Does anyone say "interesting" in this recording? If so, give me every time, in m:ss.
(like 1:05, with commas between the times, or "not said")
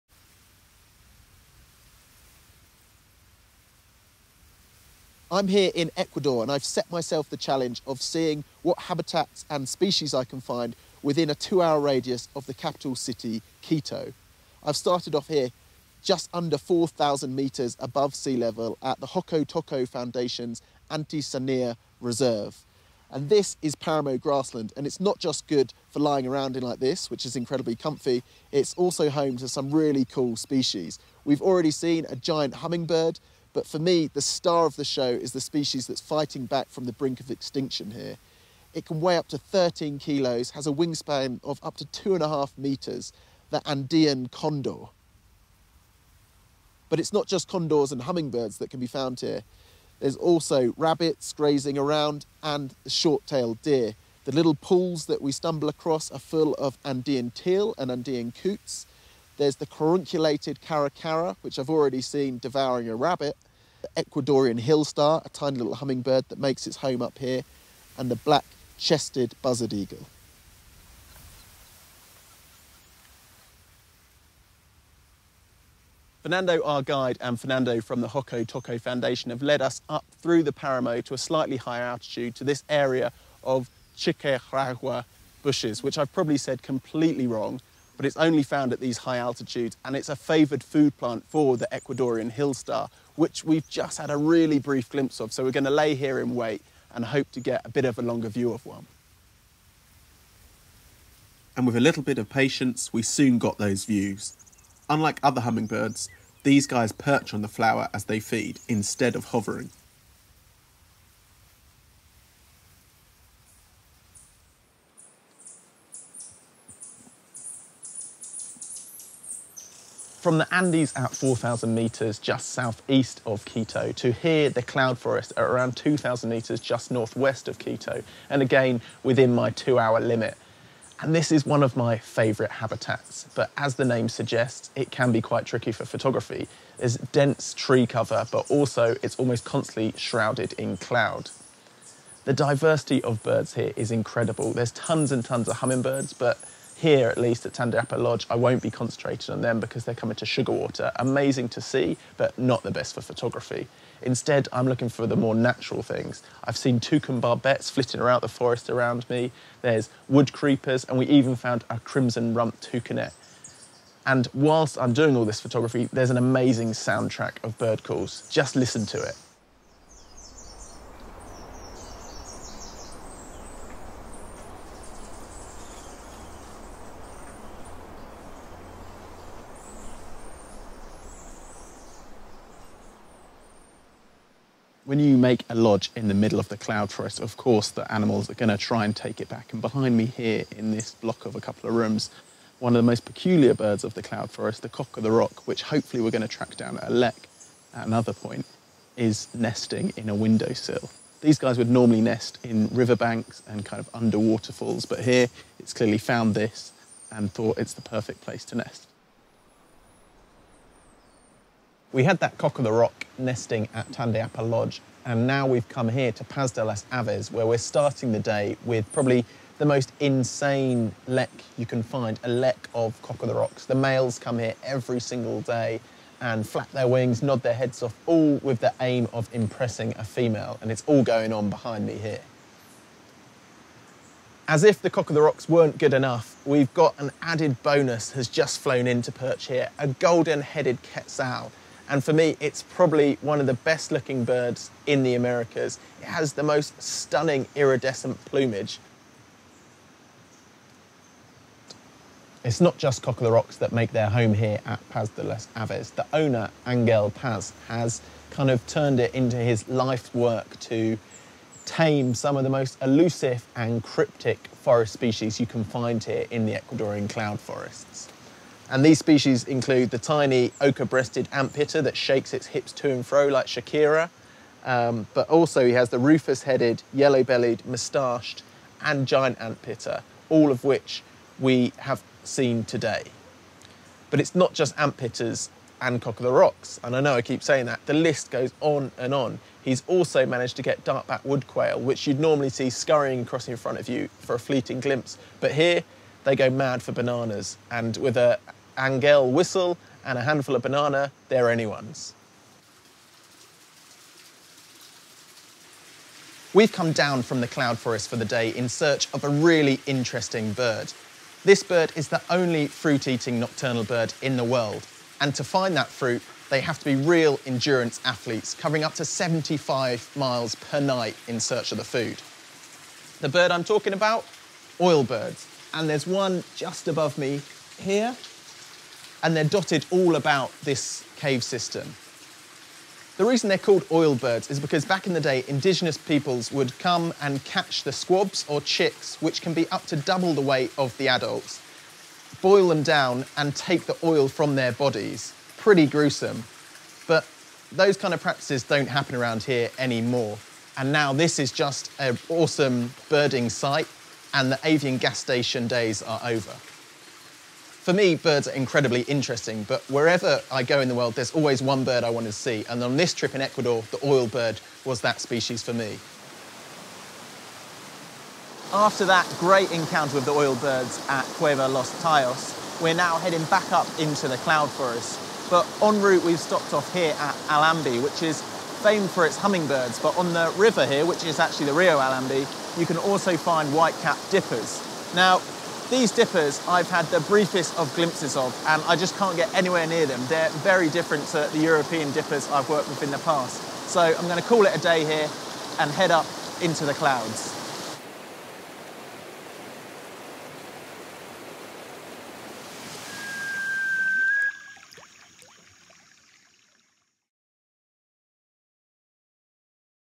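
5:09, 5:59.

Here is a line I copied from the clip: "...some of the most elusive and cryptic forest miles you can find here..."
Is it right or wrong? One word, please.
wrong.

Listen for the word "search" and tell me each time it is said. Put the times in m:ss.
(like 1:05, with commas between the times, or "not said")
5:08, 5:21.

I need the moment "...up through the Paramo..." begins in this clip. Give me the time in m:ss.
1:19.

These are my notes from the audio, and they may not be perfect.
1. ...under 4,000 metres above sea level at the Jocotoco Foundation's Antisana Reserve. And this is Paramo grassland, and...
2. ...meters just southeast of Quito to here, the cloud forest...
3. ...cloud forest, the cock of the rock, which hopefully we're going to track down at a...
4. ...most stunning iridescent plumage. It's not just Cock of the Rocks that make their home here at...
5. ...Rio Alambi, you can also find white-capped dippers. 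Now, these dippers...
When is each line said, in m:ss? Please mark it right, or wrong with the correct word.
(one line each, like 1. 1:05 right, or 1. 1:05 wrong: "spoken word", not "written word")
1. 0:16 right
2. 2:01 right
3. 3:14 right
4. 4:06 right
5. 6:21 right.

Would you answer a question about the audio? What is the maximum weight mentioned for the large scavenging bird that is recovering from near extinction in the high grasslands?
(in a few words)
13 kilos.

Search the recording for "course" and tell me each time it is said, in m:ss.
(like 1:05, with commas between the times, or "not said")
3:07.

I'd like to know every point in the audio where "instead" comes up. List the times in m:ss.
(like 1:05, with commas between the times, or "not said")
1:48, 2:34.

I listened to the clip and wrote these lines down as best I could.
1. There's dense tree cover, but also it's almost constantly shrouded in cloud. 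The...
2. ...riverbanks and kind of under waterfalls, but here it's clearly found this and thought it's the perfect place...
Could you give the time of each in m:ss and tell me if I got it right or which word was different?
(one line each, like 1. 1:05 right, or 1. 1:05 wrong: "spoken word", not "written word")
1. 2:16 right
2. 3:22 right.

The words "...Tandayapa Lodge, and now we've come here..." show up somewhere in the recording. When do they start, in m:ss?
3:33.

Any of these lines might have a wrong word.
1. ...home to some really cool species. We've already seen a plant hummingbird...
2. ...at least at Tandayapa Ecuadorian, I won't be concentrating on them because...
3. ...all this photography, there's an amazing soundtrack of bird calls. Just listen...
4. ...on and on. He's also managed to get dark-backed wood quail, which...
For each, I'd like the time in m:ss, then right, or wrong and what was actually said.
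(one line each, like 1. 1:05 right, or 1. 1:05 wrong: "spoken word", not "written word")
1. 0:29 wrong: "giant", not "plant"
2. 2:27 wrong: "Lodge", not "Ecuadorian"
3. 2:45 right
4. 4:48 right.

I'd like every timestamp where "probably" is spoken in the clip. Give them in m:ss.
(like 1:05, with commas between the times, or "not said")
1:26, 3:38, 4:02.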